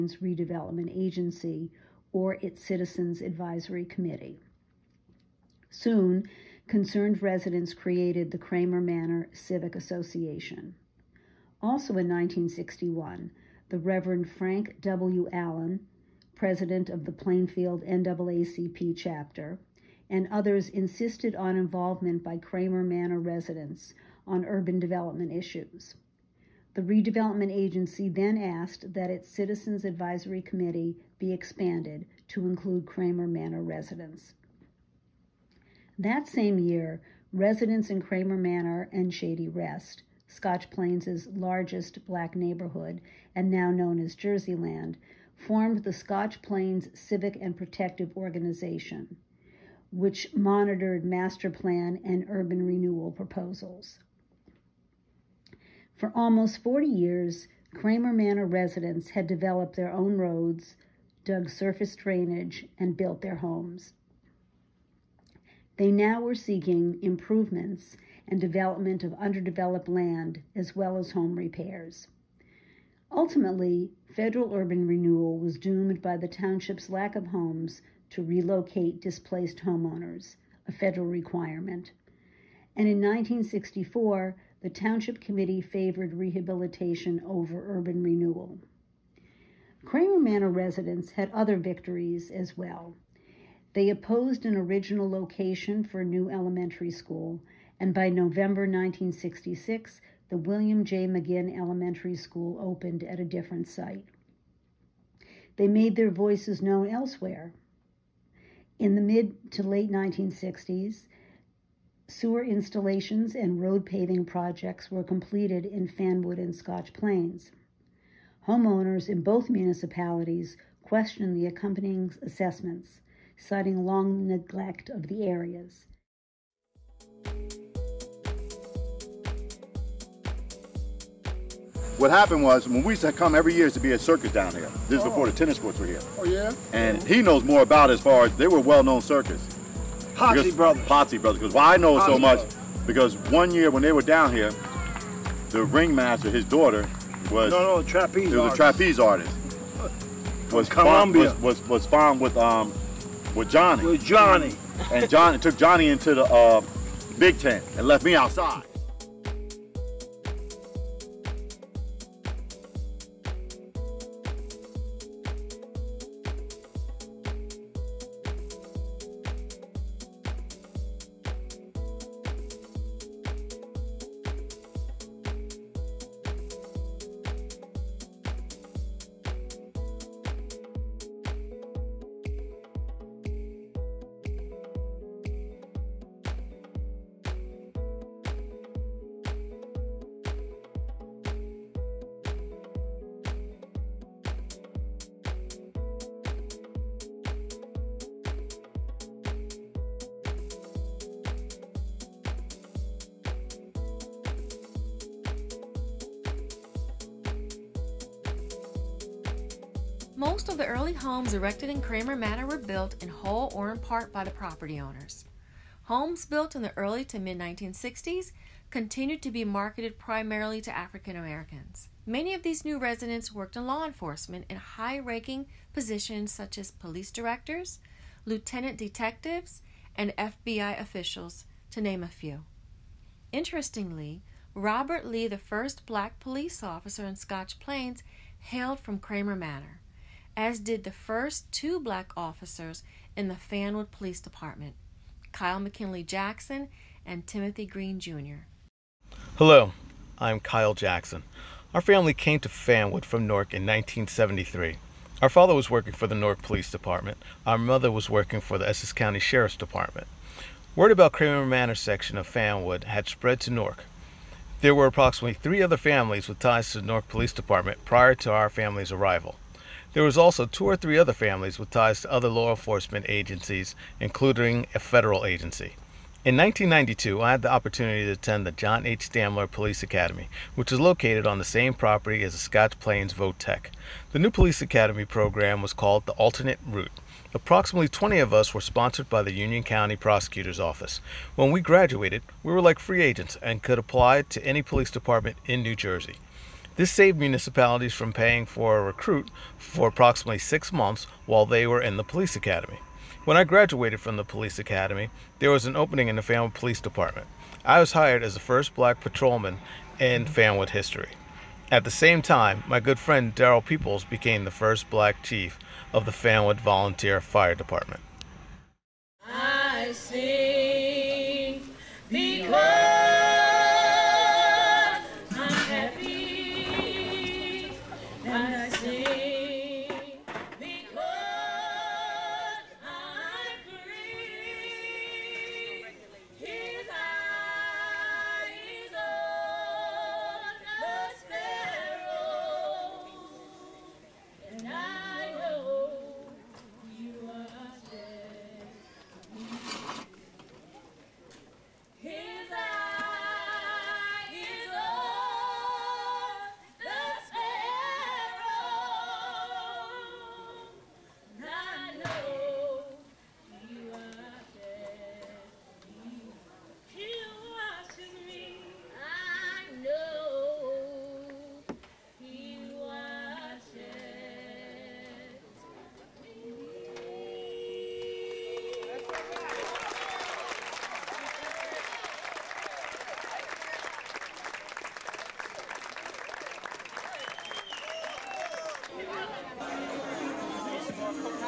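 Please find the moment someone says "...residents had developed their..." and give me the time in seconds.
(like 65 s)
58 s.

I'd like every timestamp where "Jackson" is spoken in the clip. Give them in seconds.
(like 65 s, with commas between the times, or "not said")
246 s, 250 s.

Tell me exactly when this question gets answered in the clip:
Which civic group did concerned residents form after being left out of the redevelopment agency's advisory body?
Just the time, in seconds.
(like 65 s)
8 s.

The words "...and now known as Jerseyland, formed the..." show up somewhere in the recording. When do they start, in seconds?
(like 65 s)
43 s.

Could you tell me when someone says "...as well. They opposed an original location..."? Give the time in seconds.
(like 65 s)
92 s.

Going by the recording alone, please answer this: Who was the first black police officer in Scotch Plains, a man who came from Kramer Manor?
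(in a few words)
Robert Lee.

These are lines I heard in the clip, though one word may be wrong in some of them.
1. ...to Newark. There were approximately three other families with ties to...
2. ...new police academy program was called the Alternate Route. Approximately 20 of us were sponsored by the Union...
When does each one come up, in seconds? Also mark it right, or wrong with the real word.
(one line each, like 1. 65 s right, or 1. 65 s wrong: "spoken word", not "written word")
1. 263 s right
2. 284 s right.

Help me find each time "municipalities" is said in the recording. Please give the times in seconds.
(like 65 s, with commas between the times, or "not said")
119 s, 297 s.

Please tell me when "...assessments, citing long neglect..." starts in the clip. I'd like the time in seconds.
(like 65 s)
122 s.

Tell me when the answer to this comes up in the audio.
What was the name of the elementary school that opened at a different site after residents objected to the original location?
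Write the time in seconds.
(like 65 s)
100 s.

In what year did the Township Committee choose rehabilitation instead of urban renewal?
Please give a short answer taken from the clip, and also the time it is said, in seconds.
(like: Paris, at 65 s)
1964, at 82 s.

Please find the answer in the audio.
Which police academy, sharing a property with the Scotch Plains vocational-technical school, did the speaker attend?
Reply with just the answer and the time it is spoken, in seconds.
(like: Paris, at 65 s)
John H. Stamler Police Academy, at 278 s.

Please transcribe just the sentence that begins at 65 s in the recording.
They now were seeking improvements and development of underdeveloped land as well as home repairs.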